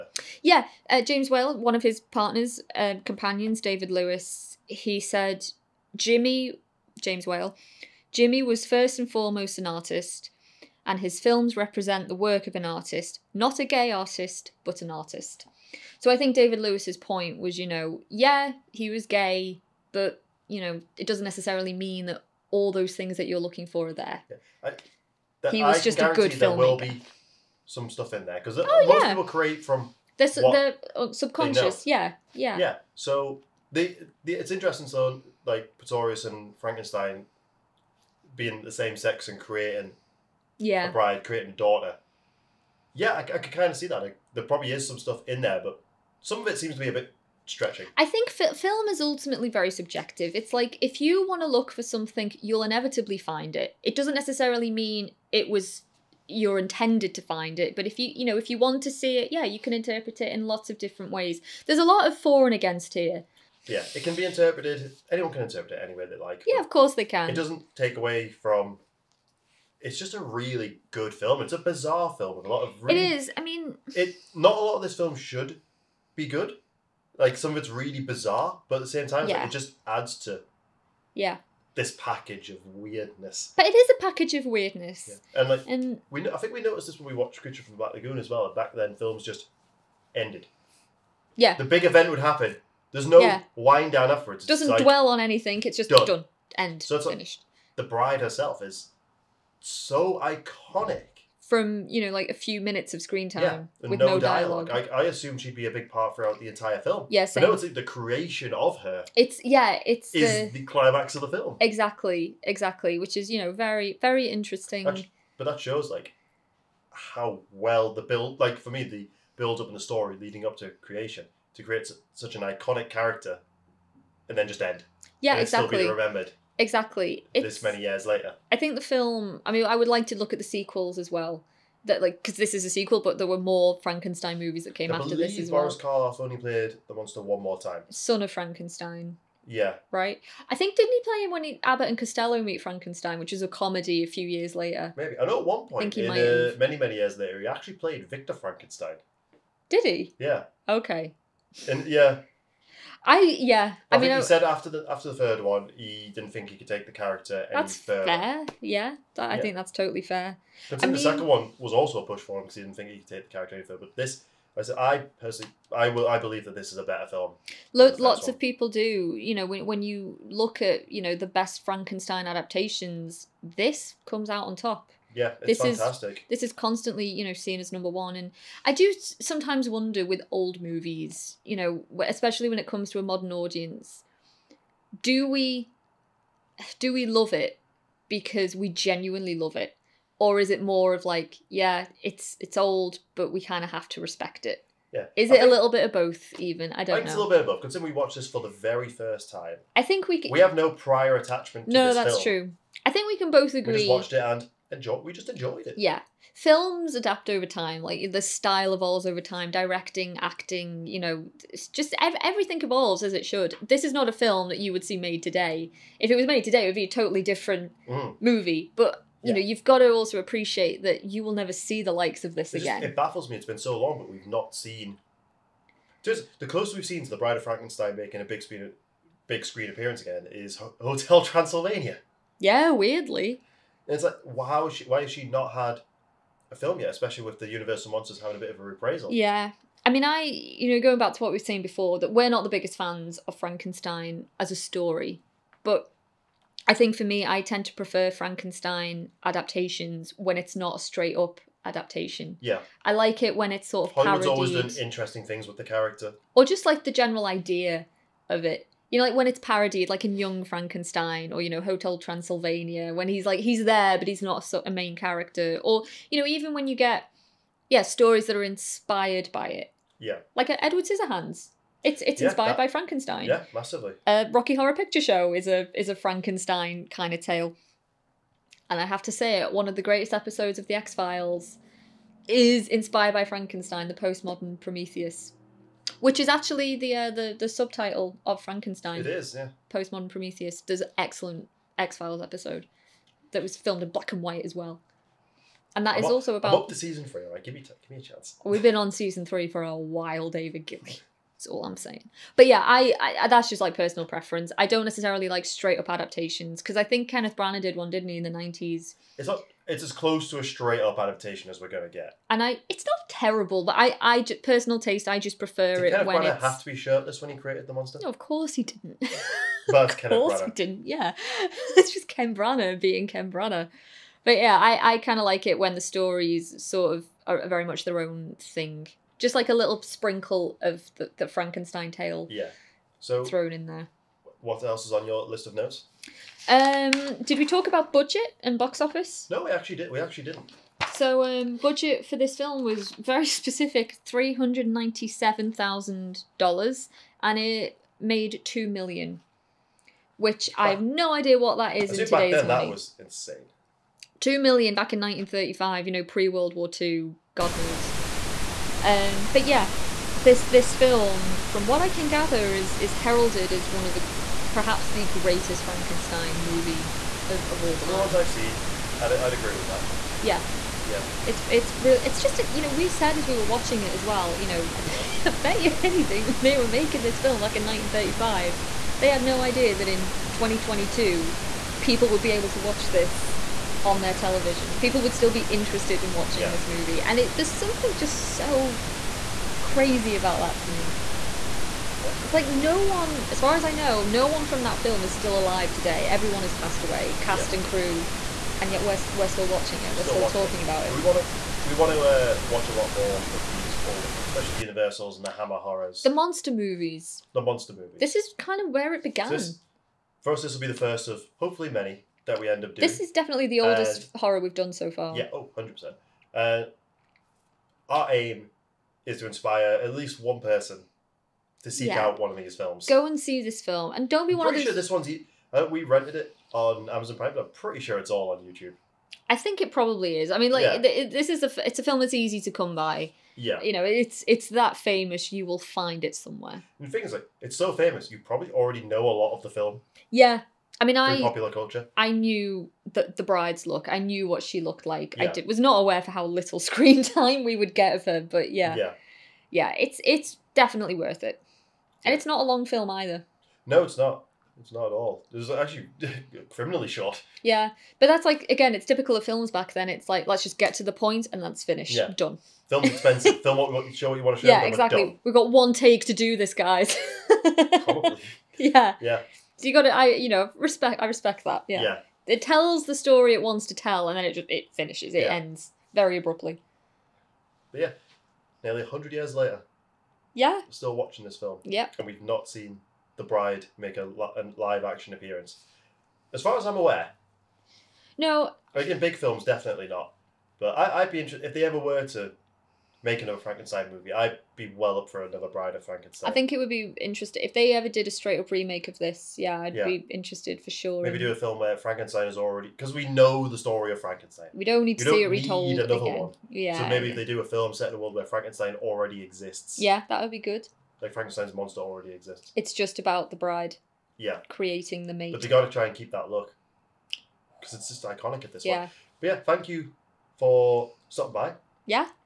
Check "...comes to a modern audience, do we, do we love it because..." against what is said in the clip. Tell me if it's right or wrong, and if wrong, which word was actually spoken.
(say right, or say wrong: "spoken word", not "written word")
right.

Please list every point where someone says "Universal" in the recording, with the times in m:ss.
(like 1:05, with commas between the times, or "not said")
3:57, 6:44.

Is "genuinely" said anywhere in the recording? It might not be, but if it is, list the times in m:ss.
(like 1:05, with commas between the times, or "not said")
3:08.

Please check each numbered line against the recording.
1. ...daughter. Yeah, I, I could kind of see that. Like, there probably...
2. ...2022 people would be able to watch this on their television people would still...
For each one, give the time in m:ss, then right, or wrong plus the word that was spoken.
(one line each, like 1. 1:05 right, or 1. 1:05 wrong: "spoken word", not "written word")
1. 0:41 right
2. 6:20 right.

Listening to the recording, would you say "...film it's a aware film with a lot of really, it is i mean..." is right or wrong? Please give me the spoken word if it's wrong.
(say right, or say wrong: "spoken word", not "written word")
wrong: "bizarre", not "aware".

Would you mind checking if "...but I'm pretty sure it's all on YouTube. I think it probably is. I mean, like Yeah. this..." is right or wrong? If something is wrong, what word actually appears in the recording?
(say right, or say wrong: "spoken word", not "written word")
right.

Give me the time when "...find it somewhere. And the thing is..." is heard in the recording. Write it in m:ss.
7:15.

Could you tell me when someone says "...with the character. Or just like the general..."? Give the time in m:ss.
4:15.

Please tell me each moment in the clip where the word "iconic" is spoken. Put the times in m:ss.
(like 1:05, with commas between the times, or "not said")
1:40, 2:02, 8:38.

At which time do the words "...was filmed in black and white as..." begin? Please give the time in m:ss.
4:53.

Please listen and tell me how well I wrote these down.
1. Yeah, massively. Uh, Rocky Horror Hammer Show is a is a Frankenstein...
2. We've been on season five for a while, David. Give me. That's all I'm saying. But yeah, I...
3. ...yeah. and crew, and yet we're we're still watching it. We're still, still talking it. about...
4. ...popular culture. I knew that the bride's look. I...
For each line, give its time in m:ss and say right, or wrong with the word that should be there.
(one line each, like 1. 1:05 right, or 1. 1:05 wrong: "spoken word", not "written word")
1. 4:33 wrong: "Picture", not "Hammer"
2. 4:58 wrong: "three", not "five"
3. 6:37 right
4. 7:21 right.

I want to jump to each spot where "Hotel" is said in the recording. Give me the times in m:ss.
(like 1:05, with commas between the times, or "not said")
3:50, 4:21.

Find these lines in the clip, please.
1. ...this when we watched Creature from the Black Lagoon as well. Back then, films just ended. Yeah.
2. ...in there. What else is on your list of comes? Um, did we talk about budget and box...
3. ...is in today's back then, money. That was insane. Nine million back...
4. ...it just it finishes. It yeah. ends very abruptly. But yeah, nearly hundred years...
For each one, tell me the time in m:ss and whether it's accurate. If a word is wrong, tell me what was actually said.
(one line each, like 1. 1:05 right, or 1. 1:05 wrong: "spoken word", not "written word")
1. 1:26 right
2. 5:33 wrong: "notes", not "comes"
3. 5:51 wrong: "Two", not "Nine"
4. 7:54 right.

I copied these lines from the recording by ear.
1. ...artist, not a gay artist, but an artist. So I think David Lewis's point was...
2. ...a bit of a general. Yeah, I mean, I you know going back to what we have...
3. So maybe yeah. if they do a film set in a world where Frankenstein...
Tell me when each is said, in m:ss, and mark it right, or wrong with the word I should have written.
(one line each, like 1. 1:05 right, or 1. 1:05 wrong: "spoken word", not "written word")
1. 0:12 right
2. 3:58 wrong: "reprisal", not "general"
3. 8:26 right.